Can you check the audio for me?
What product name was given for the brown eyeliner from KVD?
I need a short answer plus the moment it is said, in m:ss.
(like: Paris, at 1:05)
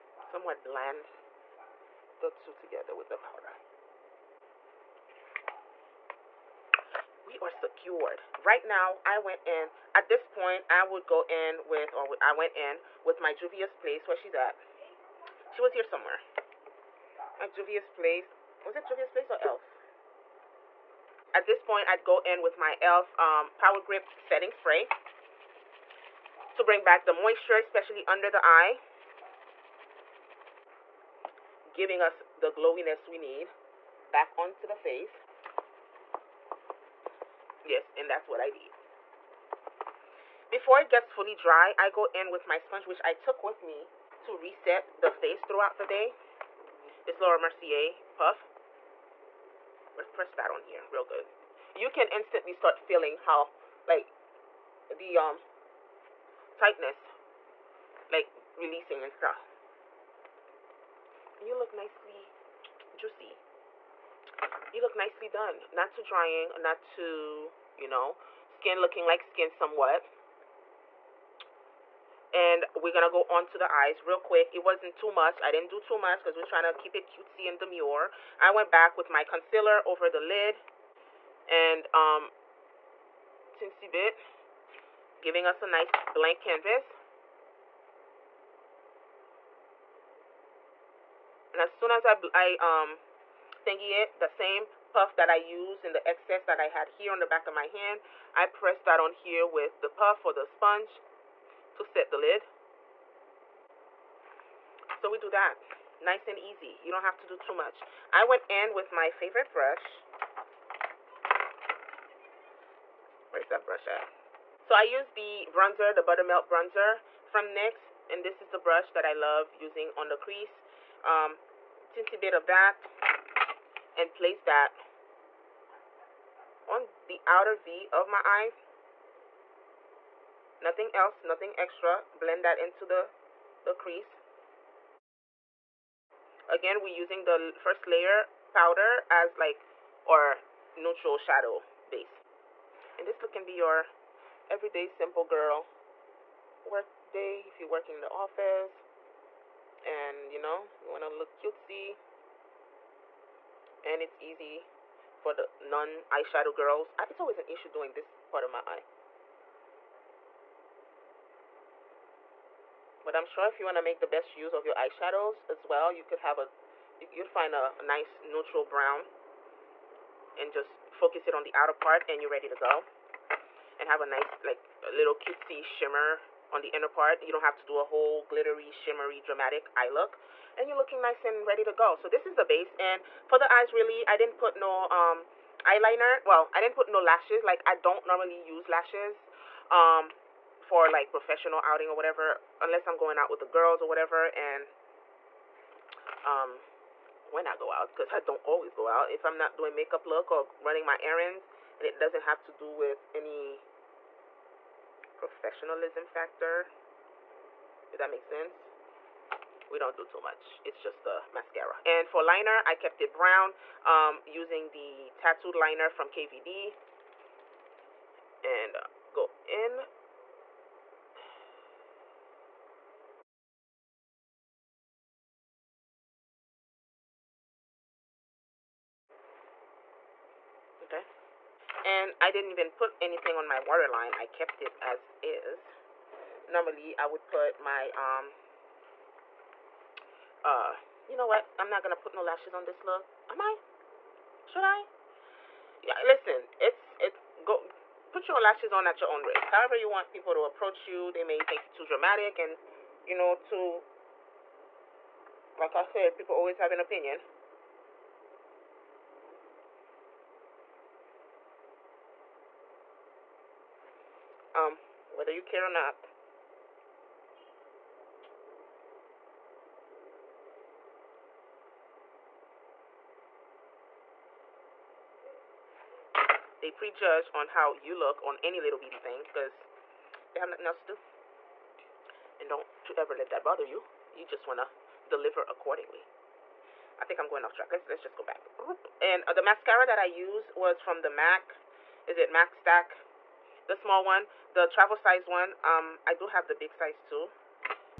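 Tattooed liner, at 3:35.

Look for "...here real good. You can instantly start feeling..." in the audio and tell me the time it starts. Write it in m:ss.
0:50.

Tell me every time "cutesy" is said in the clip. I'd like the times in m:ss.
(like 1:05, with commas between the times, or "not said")
1:17, 2:31, 2:55.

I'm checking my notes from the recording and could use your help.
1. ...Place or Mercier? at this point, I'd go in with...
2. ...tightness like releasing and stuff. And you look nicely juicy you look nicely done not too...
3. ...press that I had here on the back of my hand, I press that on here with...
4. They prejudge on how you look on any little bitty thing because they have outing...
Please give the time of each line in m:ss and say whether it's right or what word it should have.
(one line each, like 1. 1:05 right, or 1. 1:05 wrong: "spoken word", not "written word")
1. 0:19 wrong: "Elf", not "Mercier"
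2. 0:56 right
3. 1:36 wrong: "excess", not "press"
4. 4:36 wrong: "nothing", not "outing".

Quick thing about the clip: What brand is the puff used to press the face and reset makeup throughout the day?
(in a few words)
Laura Mercier.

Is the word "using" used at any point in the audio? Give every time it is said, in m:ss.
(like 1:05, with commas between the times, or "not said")
1:59, 2:16, 3:34.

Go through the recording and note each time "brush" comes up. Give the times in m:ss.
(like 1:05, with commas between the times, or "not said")
1:49, 1:53, 1:58.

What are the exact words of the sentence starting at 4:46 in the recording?
I think I'm going off track.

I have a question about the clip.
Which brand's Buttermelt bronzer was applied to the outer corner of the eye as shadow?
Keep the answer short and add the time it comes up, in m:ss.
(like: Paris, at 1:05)
NYX, at 1:57.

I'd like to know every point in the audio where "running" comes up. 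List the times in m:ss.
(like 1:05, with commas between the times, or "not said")
3:20.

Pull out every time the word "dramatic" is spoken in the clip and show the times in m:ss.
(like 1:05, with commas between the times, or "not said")
2:59, 4:11.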